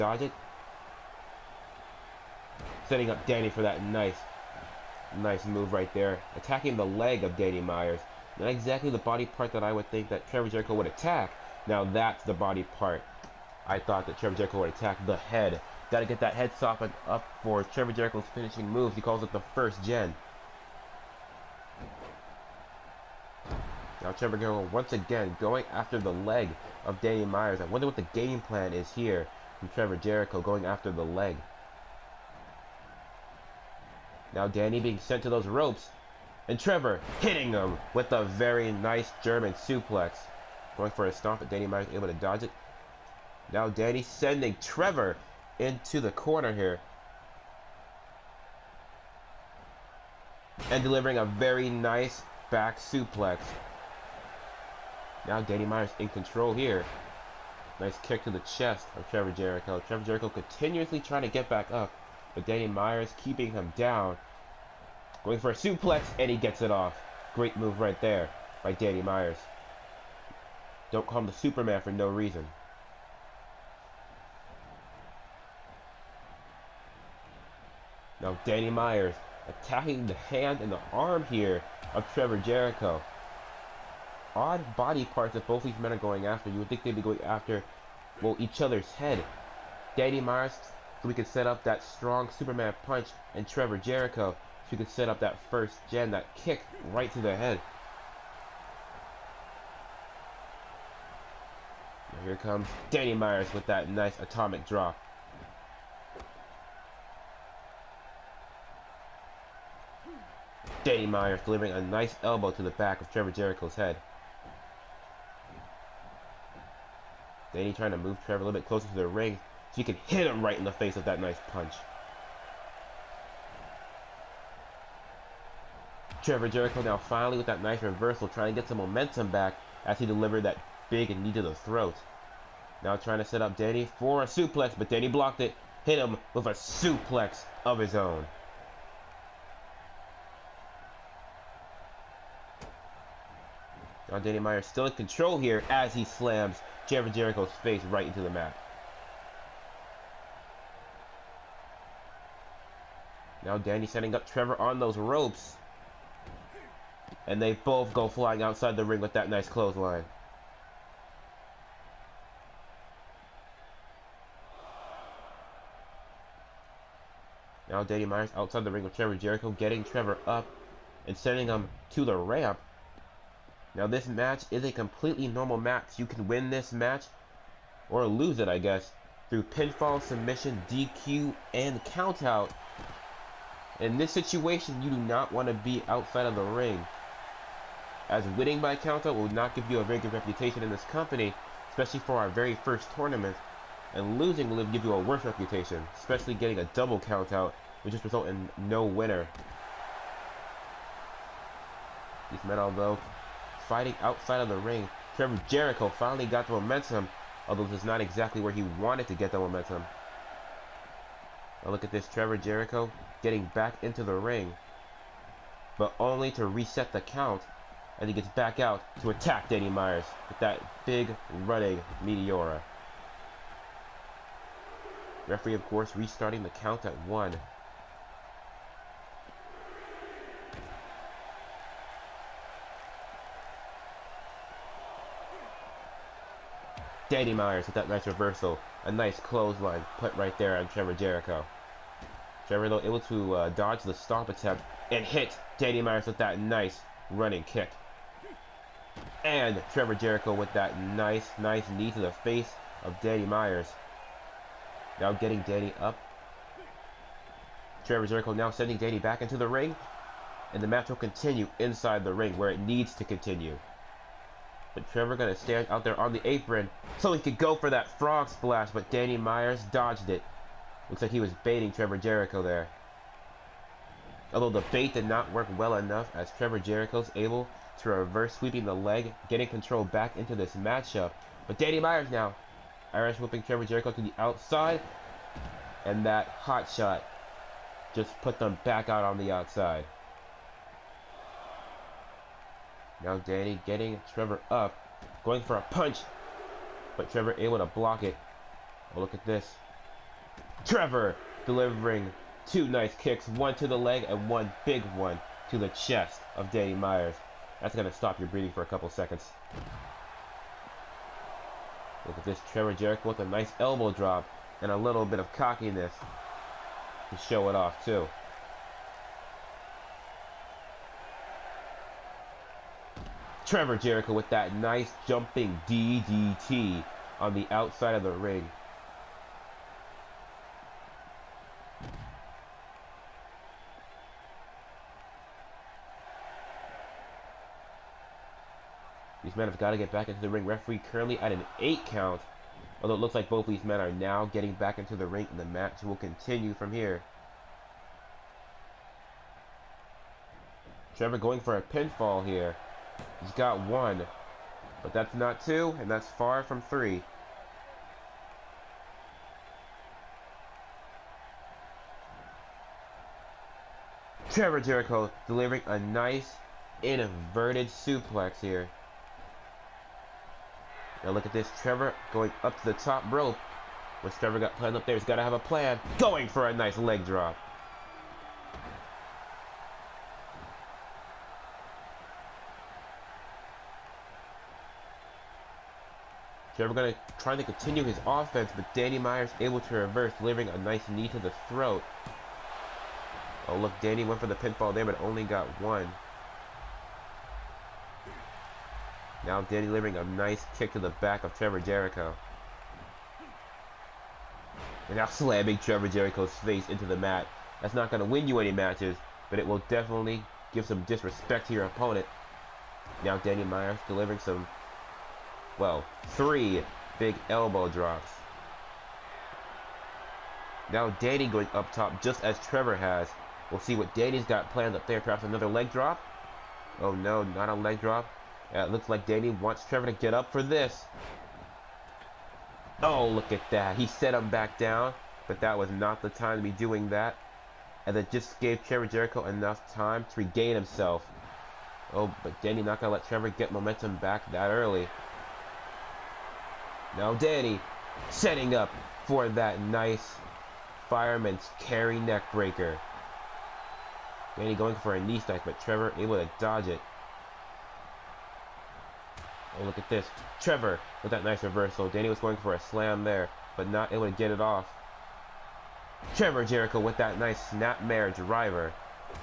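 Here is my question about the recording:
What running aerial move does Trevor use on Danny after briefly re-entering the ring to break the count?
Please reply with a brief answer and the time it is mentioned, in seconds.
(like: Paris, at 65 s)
Running Meteora, at 221 s.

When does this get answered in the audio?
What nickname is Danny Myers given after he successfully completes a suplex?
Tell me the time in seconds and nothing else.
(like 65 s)
71 s.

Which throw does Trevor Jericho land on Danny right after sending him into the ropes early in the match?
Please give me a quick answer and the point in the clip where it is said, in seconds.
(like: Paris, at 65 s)
German suplex, at 39 s.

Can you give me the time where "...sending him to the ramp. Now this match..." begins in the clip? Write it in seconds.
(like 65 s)
171 s.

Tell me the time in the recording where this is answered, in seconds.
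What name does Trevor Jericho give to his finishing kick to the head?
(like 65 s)
19 s.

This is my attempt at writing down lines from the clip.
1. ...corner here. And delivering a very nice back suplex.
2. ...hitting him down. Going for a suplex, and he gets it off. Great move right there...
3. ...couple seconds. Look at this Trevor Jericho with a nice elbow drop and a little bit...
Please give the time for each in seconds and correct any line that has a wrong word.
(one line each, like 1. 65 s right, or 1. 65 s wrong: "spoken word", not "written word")
1. 46 s right
2. 63 s wrong: "keeping", not "hitting"
3. 308 s right.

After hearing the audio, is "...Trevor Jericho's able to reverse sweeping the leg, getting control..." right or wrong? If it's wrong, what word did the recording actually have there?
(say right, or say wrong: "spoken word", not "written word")
right.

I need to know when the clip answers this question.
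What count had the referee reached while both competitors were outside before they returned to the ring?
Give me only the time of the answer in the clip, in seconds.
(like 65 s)
341 s.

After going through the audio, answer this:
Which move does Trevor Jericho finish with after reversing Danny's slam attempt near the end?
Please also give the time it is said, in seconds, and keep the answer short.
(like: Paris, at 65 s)
Snapmare driver, at 467 s.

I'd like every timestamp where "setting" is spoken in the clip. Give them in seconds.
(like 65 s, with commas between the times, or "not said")
2 s, 153 s, 448 s.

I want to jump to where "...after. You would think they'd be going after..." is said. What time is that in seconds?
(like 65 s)
86 s.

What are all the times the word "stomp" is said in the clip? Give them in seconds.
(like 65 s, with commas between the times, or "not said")
41 s, 243 s.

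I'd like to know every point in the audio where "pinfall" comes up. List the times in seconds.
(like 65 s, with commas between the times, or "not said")
179 s, 351 s, 394 s.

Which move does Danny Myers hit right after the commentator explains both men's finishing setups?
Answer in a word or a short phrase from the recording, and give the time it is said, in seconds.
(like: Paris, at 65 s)
Atomic drop, at 104 s.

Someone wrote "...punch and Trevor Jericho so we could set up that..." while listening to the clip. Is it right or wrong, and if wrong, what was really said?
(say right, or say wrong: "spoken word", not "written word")
right.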